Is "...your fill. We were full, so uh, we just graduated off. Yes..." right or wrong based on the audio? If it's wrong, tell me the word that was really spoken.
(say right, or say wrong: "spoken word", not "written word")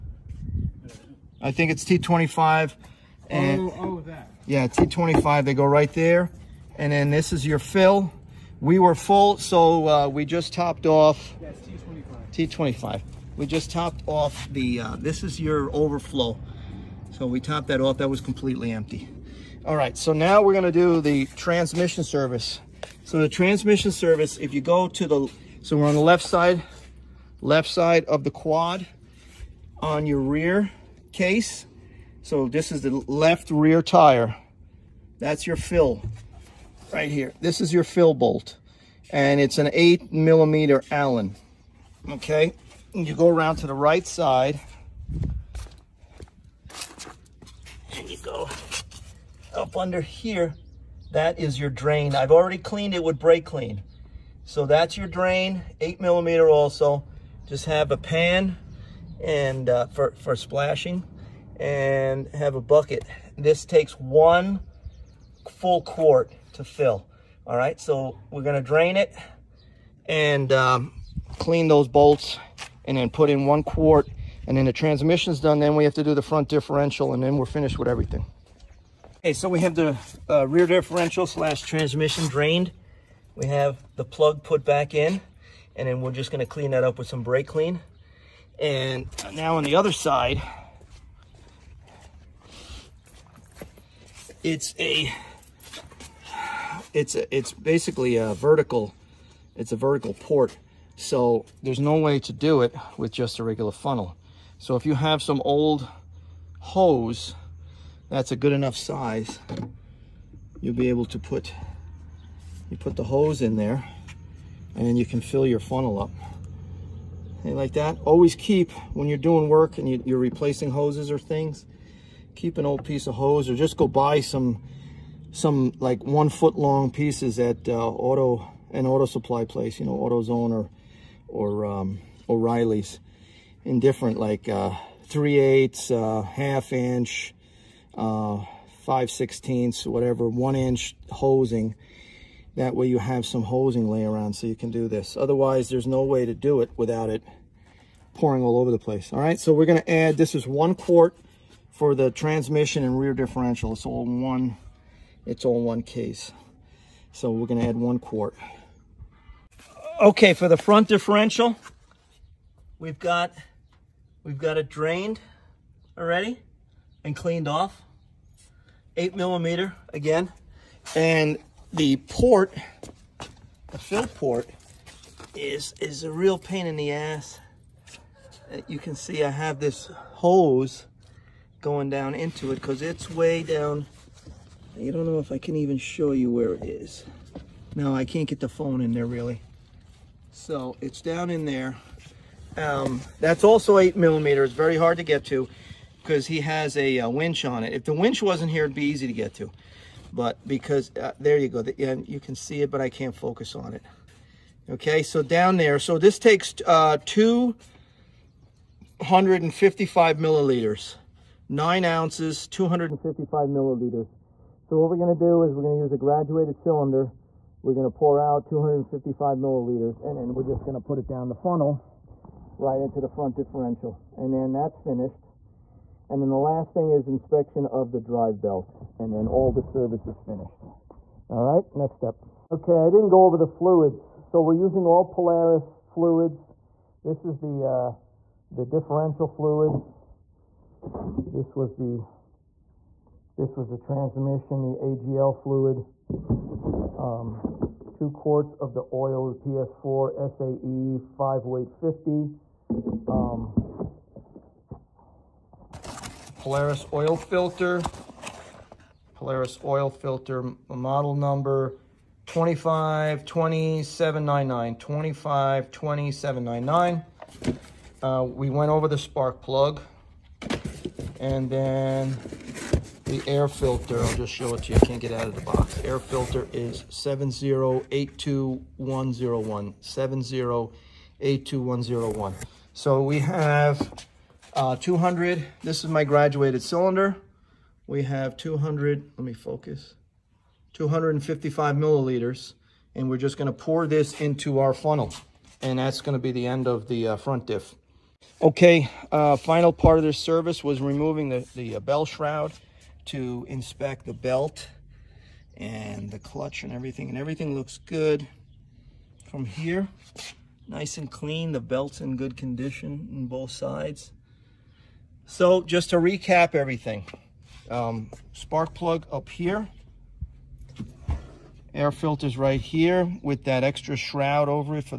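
wrong: "topped", not "graduated".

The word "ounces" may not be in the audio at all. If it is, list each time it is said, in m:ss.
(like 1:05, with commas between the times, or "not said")
3:31.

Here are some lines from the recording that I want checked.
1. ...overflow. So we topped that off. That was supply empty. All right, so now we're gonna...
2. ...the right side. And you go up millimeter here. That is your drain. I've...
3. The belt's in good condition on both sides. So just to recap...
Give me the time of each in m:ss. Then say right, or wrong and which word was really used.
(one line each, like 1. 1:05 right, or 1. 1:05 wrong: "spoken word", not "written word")
1. 0:15 wrong: "completely", not "supply"
2. 0:43 wrong: "under", not "millimeter"
3. 5:11 right.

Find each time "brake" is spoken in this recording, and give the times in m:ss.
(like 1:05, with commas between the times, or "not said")
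0:53, 1:27.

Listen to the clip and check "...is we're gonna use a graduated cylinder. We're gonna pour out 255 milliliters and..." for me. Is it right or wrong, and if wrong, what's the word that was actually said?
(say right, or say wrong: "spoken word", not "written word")
right.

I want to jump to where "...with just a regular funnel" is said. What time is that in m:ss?
1:42.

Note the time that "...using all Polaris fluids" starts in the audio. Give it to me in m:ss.
3:54.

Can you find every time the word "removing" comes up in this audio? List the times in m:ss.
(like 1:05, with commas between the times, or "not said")
5:00.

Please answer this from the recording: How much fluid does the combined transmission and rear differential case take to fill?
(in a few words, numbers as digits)
1 quart.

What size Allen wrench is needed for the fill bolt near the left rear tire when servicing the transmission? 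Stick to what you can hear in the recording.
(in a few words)
8 millimeter.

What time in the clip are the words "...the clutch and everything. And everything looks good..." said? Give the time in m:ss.
5:06.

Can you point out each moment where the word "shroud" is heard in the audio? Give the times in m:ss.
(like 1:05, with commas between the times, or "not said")
5:02, 5:23.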